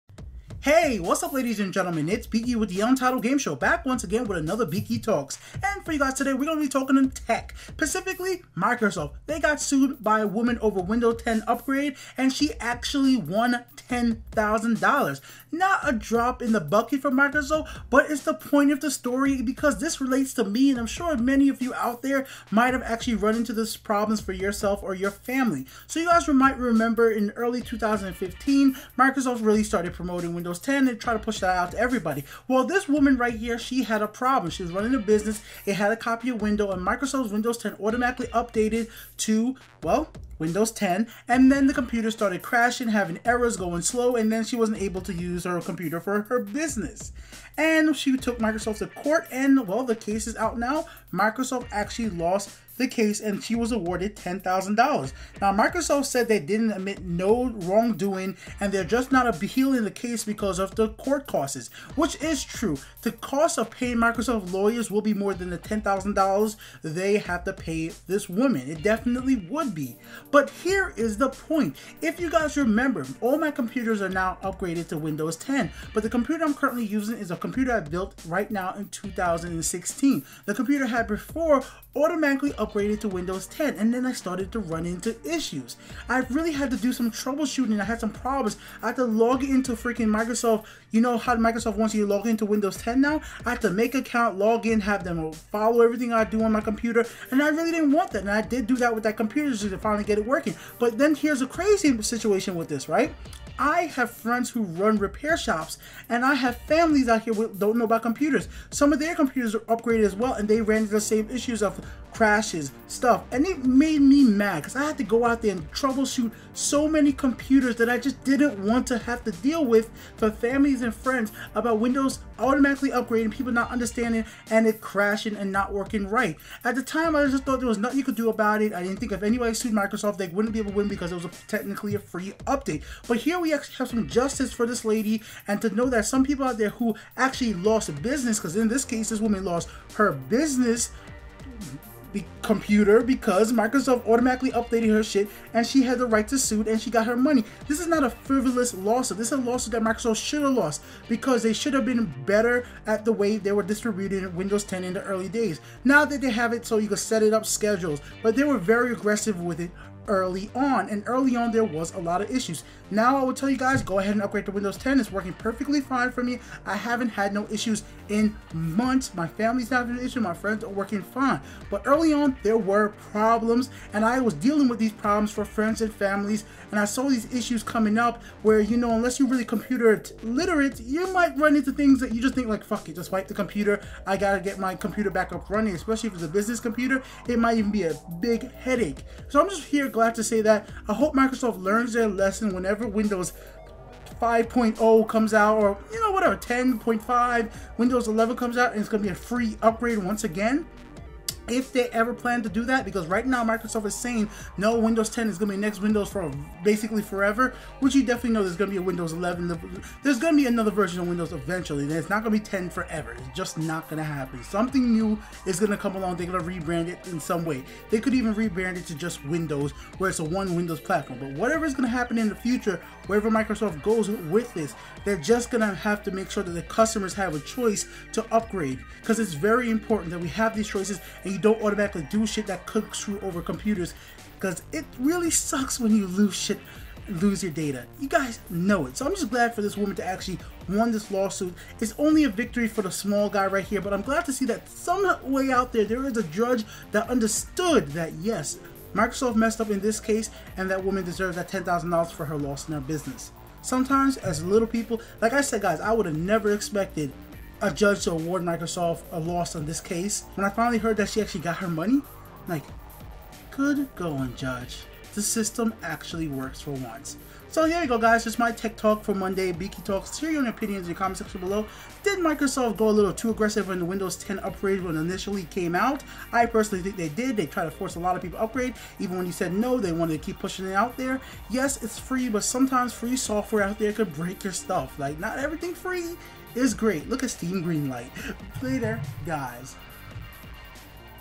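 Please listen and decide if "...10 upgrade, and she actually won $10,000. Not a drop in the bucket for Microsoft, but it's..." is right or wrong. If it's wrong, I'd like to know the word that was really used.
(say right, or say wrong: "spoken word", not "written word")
right.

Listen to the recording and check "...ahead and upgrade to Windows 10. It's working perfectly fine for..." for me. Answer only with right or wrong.
right.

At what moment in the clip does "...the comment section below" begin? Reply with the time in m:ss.
4:30.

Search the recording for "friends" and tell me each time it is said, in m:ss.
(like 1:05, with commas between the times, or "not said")
1:44, 2:00, 2:50, 2:55.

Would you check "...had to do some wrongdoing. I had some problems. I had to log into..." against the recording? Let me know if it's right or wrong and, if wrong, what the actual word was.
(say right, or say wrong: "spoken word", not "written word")
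wrong: "troubleshooting", not "wrongdoing".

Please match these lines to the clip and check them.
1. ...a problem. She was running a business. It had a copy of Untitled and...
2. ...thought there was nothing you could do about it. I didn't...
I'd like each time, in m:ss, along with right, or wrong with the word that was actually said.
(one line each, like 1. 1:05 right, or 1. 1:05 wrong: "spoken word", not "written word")
1. 0:34 wrong: "Windows", not "Untitled"
2. 2:07 right.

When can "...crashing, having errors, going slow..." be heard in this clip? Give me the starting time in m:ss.
0:42.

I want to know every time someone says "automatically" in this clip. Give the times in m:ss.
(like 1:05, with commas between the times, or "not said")
0:37, 1:21, 2:02, 2:24, 3:51.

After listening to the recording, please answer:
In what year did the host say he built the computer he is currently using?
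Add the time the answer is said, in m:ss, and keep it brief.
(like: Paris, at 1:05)
2016, at 1:18.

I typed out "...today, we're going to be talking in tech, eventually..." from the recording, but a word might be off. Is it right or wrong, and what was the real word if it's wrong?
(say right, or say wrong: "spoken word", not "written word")
wrong: "specifically", not "eventually".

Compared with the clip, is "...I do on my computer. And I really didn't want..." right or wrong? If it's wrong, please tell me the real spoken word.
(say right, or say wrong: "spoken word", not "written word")
right.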